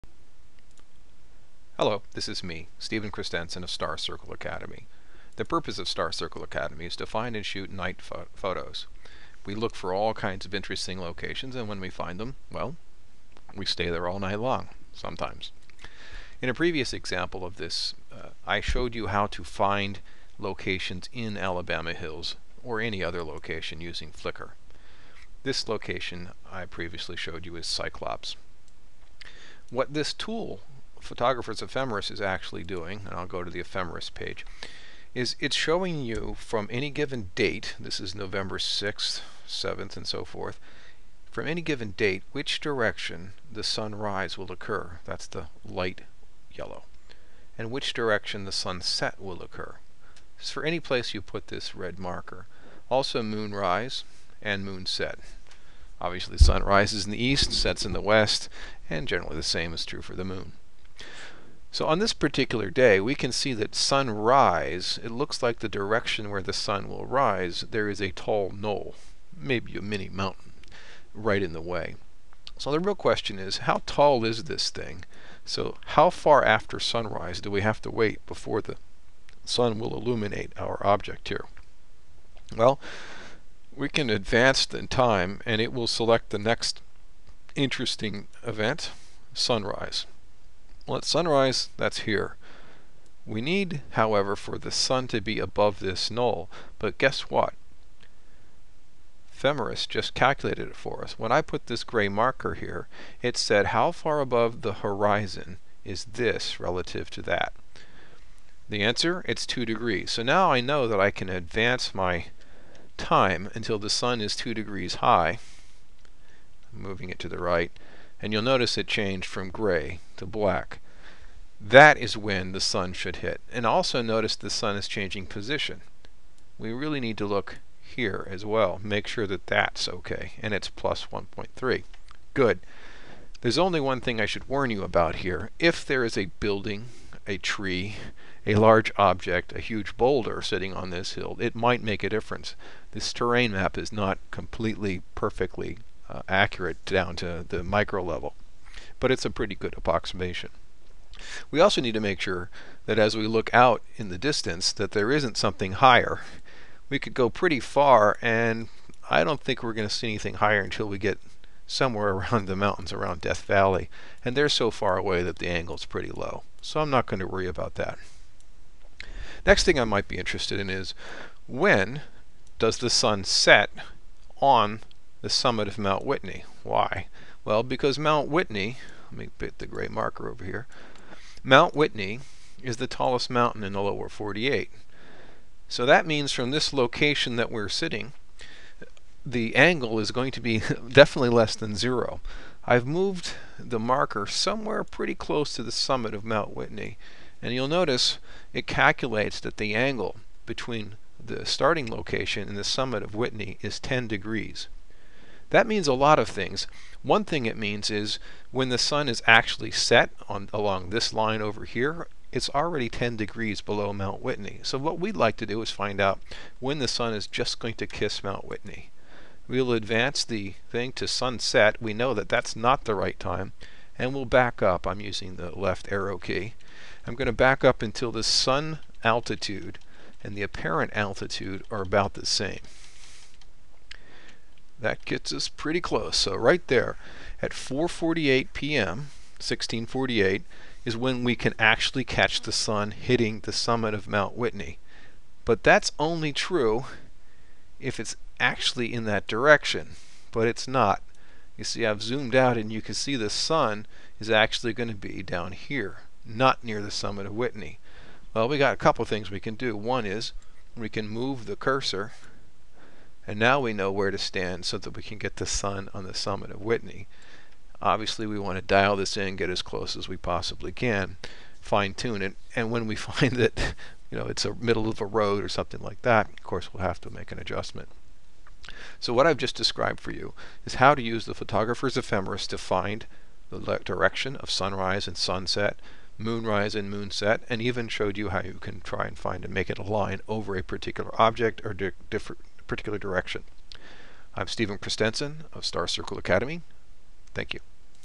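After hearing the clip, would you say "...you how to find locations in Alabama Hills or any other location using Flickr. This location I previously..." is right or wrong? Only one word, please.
right.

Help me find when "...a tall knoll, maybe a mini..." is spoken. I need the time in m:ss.
1:08.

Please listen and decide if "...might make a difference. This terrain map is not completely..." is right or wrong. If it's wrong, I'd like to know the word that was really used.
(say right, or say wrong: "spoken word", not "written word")
right.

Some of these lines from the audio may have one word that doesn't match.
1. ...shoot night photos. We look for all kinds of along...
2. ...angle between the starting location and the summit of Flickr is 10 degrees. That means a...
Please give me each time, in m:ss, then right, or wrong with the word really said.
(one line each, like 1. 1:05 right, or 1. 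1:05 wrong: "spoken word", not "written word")
1. 0:07 wrong: "interesting", not "along"
2. 3:19 wrong: "Whitney", not "Flickr".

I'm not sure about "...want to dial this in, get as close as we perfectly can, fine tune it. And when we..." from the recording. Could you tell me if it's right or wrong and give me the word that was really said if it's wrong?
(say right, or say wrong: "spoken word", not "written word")
wrong: "possibly", not "perfectly".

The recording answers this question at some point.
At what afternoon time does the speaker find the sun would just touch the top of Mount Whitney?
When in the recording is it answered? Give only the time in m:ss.
3:57.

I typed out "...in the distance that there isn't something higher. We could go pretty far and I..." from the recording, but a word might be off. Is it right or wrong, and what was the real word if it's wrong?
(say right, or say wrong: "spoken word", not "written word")
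right.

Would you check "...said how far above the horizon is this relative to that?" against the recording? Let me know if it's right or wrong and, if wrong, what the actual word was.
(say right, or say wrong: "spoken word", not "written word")
right.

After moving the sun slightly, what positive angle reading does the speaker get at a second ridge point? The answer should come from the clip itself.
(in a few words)
+1.3.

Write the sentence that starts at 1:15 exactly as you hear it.
So how far after sunrise do we have to wait before the sun will illuminate our object here?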